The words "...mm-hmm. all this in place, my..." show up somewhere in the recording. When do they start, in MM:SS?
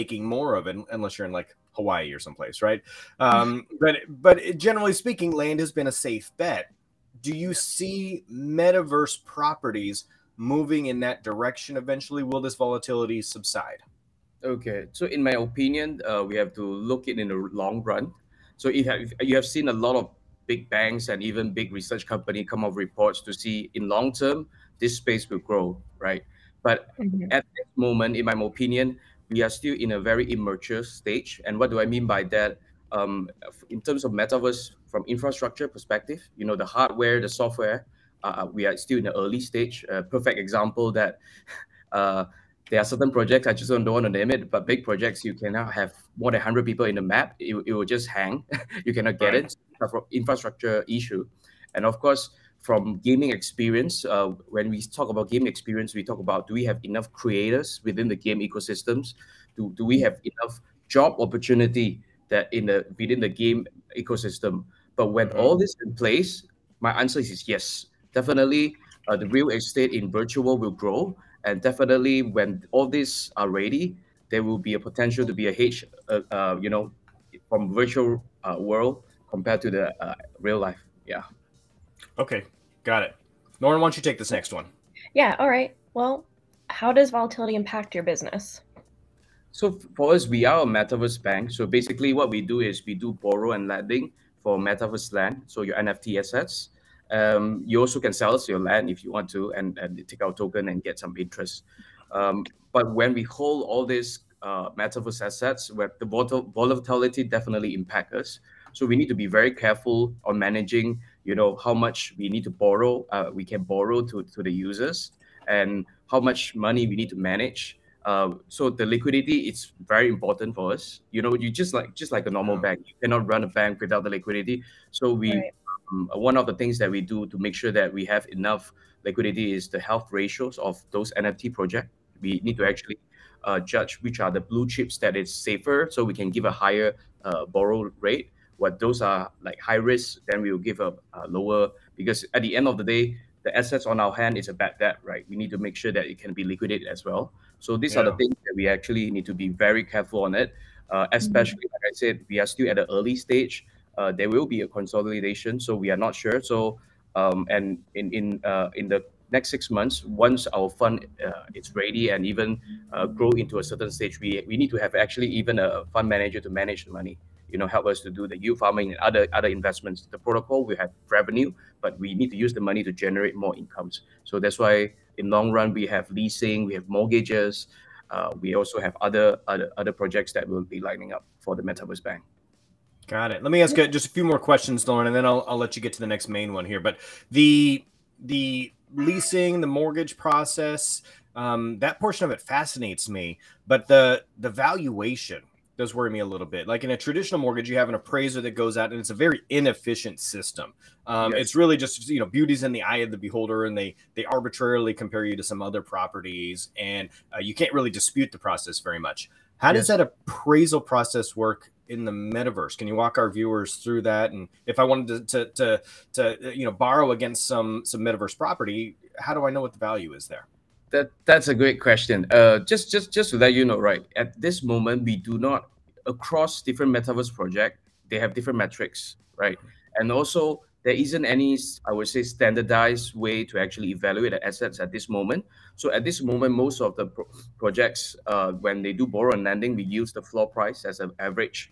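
01:05.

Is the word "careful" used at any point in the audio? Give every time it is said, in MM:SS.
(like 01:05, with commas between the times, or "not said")
01:49, 02:29.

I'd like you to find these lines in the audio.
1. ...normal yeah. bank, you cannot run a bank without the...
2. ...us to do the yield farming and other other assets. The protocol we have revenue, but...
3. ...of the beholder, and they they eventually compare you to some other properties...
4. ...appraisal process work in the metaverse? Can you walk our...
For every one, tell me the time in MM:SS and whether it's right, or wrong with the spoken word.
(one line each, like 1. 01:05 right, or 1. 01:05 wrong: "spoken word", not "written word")
1. 02:02 right
2. 02:47 wrong: "investments", not "assets"
3. 03:22 wrong: "arbitrarily", not "eventually"
4. 03:29 right.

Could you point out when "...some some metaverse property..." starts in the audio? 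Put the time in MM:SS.
03:37.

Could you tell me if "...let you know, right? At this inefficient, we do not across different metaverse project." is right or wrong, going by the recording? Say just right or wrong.
wrong.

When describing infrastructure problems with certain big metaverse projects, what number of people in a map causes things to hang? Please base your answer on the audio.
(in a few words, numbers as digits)
100.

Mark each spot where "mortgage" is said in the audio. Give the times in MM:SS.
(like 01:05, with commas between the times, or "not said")
02:56, 03:09, 03:17.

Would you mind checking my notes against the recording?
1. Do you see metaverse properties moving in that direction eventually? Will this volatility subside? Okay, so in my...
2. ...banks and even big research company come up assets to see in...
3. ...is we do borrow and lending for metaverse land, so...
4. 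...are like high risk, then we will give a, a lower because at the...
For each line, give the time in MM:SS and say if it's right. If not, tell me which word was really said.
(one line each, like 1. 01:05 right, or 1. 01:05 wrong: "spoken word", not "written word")
1. 00:07 right
2. 00:20 wrong: "reports", not "assets"
3. 01:32 right
4. 02:19 right.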